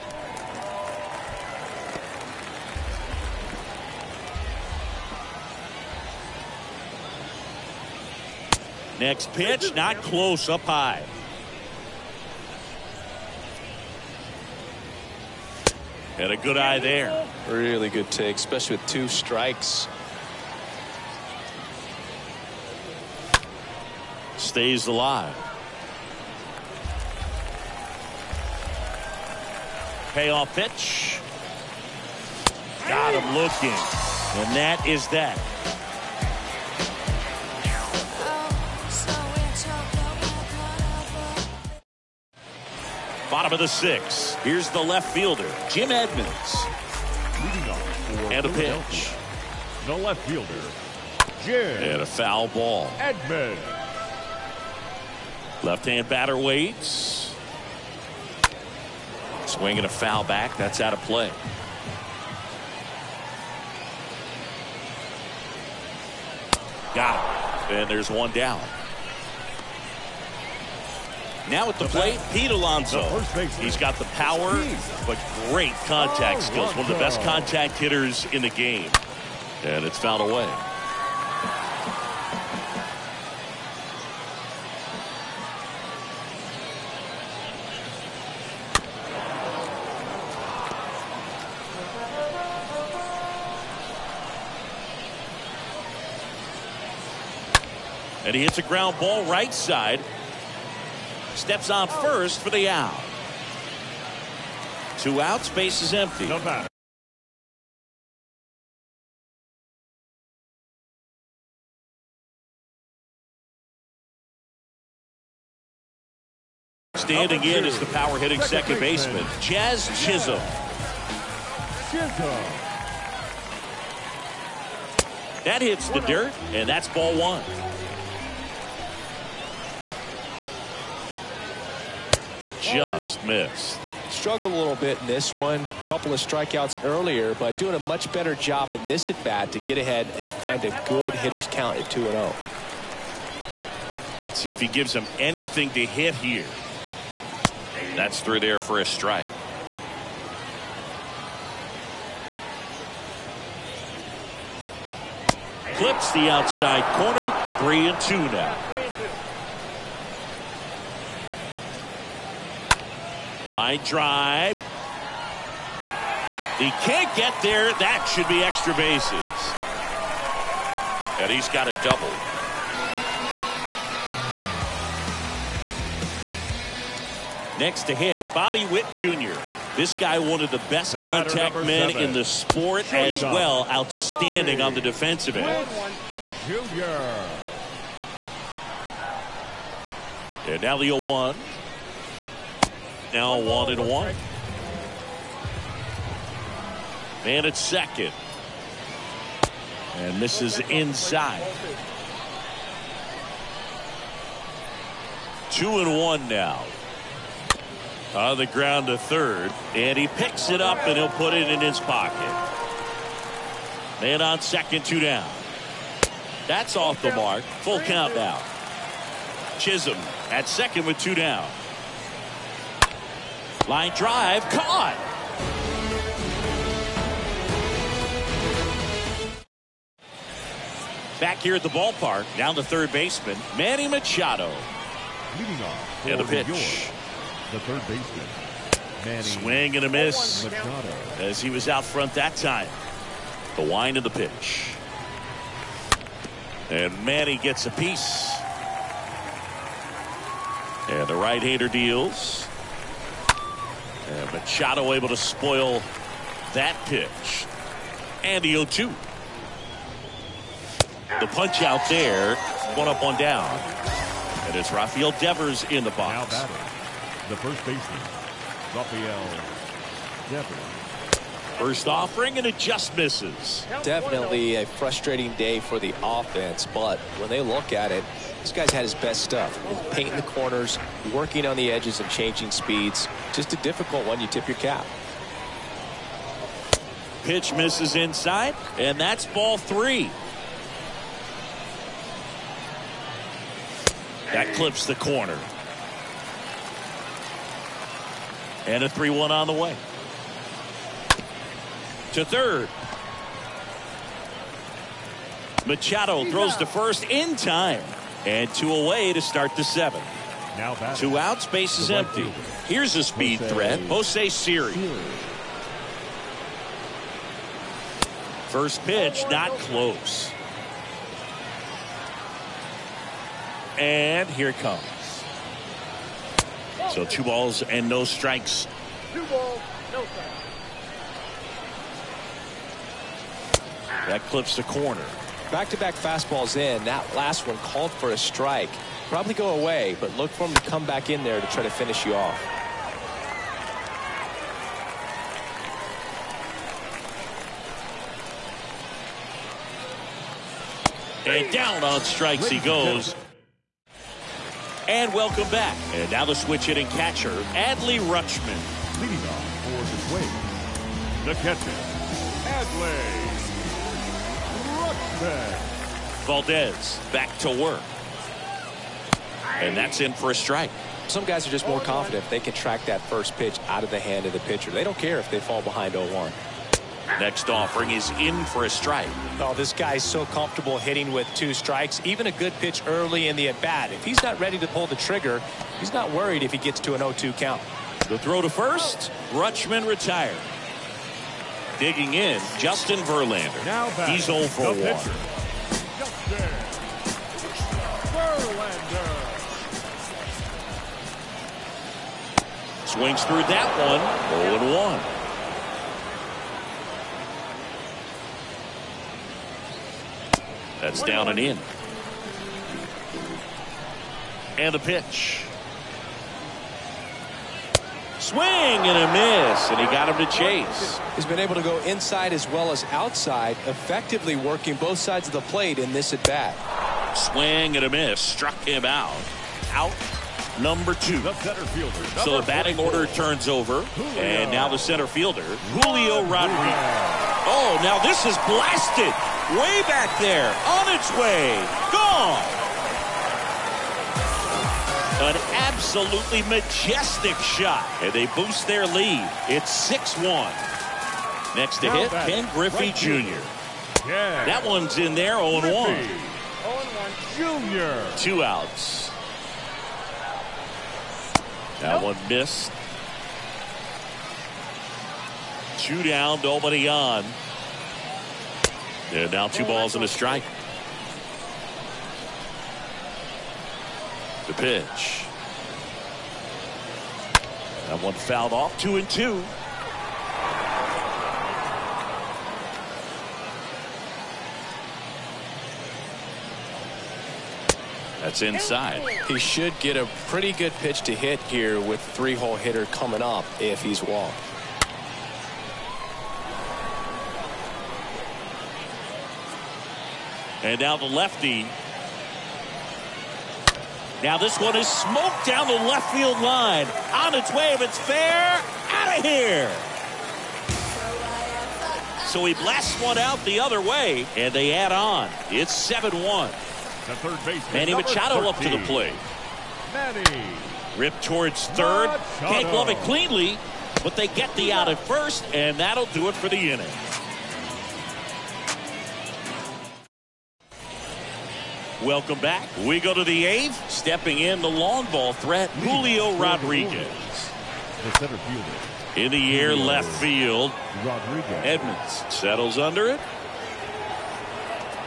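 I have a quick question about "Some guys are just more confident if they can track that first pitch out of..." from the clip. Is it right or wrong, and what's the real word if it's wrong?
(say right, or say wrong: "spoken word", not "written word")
right.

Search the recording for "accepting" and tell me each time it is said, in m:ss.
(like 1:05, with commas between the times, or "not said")
not said.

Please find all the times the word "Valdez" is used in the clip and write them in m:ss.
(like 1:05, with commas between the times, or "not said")
6:05.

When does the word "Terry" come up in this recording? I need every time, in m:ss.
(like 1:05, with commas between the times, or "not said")
not said.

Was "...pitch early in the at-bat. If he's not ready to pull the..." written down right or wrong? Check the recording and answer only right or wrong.
right.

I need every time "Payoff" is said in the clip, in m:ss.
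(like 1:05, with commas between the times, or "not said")
0:30.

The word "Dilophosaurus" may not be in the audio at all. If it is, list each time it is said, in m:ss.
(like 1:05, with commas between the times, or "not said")
not said.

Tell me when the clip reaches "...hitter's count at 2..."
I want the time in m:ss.
2:21.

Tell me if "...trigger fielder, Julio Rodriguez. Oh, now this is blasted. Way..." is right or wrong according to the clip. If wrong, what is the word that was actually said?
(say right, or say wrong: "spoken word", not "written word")
wrong: "center", not "trigger".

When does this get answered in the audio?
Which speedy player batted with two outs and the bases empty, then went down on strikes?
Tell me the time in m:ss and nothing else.
5:13.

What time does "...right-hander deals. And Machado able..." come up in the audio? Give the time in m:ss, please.
4:11.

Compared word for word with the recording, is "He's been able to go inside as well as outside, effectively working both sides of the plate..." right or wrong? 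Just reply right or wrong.
right.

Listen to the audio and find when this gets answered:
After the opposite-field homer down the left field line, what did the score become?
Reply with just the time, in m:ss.
8:35.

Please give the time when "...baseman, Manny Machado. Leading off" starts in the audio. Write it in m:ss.
3:52.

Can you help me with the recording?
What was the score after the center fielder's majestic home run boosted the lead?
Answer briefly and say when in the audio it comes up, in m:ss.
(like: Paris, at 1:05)
6-1, at 7:29.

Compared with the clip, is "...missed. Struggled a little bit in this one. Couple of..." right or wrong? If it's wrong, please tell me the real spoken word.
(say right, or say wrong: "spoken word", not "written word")
right.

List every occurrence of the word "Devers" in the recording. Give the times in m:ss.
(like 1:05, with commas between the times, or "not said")
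4:25, 4:30.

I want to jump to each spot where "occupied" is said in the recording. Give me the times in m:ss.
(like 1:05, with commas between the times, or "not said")
not said.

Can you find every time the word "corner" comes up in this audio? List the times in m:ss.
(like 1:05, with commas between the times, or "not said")
2:36, 4:40, 4:54, 5:34.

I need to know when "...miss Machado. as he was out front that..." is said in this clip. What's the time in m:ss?
3:59.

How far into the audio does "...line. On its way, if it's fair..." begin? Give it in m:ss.
8:26.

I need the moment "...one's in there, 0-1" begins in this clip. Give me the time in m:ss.
7:34.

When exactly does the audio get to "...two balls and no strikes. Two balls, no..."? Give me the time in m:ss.
5:27.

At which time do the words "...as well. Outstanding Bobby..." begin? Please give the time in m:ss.
3:02.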